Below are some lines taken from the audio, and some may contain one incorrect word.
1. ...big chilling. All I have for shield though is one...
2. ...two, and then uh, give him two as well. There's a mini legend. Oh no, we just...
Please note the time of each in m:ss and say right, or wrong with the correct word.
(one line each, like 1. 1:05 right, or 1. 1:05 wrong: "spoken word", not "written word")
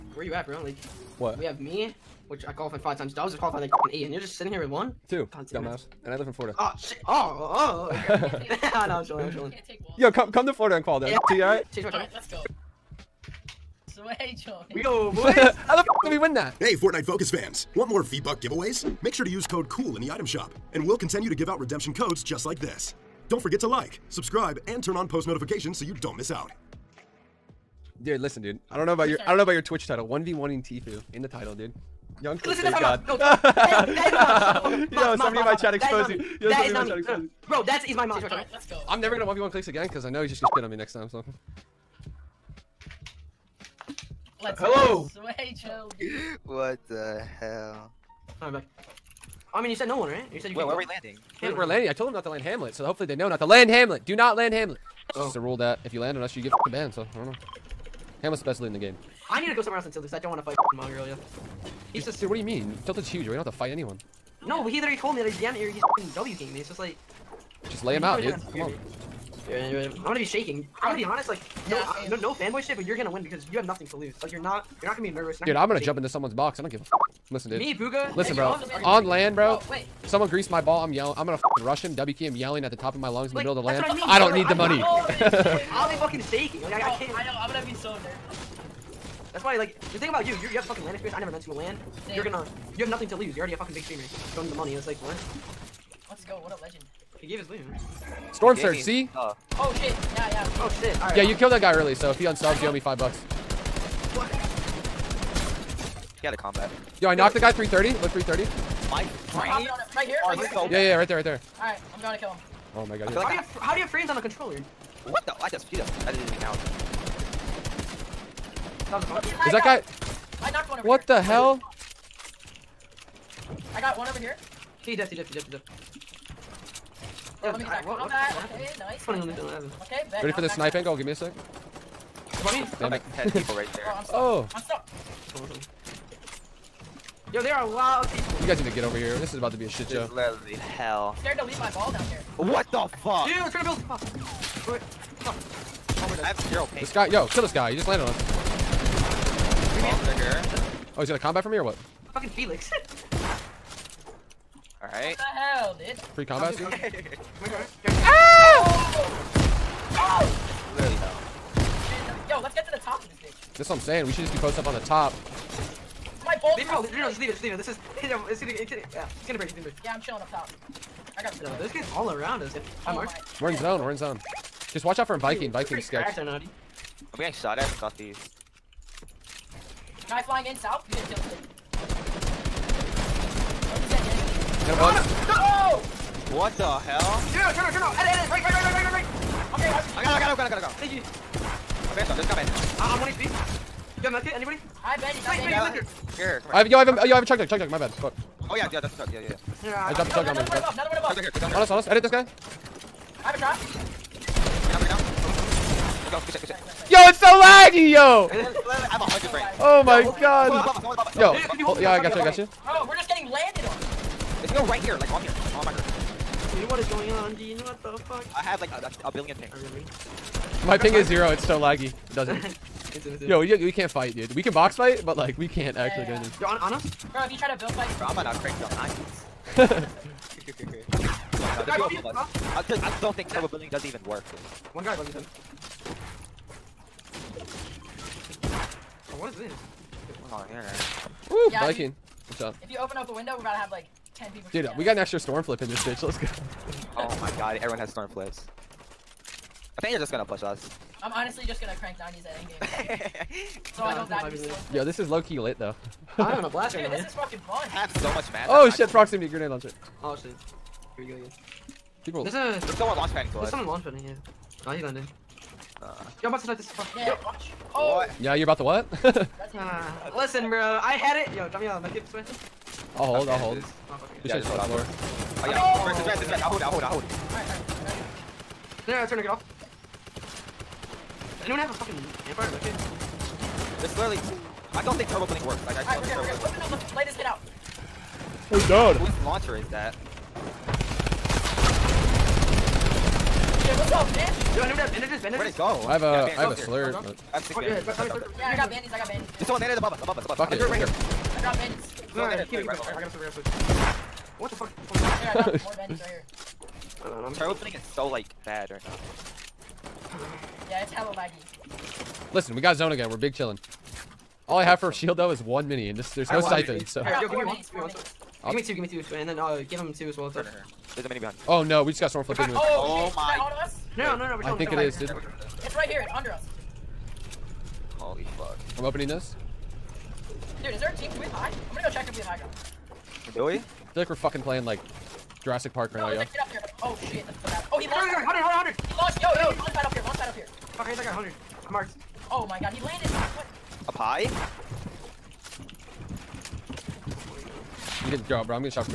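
1. 5:13 right
2. 5:18 wrong: "behind", not "legend".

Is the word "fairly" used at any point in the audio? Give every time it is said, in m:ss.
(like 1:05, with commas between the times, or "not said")
not said.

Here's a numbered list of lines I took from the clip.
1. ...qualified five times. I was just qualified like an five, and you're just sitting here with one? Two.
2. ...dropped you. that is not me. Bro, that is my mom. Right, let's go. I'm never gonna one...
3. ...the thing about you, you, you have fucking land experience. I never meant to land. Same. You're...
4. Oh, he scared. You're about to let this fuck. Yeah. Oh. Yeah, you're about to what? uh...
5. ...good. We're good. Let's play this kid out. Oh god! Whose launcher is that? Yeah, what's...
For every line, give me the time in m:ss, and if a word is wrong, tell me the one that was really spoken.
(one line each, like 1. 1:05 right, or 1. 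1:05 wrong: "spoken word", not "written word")
1. 0:02 wrong: "eight", not "five"
2. 0:35 wrong: "exposed", not "dropped"
3. 1:29 right
4. 4:24 wrong: "landed", not "scared"
5. 4:46 right.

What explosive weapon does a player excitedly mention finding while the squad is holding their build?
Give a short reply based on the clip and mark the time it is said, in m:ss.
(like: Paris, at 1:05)
proximity grenade launcher, at 4:18.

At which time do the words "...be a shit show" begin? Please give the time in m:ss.
2:19.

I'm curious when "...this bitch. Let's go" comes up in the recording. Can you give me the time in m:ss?
4:05.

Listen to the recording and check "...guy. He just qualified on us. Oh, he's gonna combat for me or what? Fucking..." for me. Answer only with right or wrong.
wrong.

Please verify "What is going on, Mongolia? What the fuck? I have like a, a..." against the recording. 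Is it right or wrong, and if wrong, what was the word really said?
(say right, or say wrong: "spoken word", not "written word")
wrong: "Dean", not "Mongolia".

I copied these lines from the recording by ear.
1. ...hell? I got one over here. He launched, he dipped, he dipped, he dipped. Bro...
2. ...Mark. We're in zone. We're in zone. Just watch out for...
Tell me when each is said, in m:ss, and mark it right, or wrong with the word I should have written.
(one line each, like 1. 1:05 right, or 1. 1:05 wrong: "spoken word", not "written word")
1. 2:01 wrong: "dipped", not "launched"
2. 2:52 right.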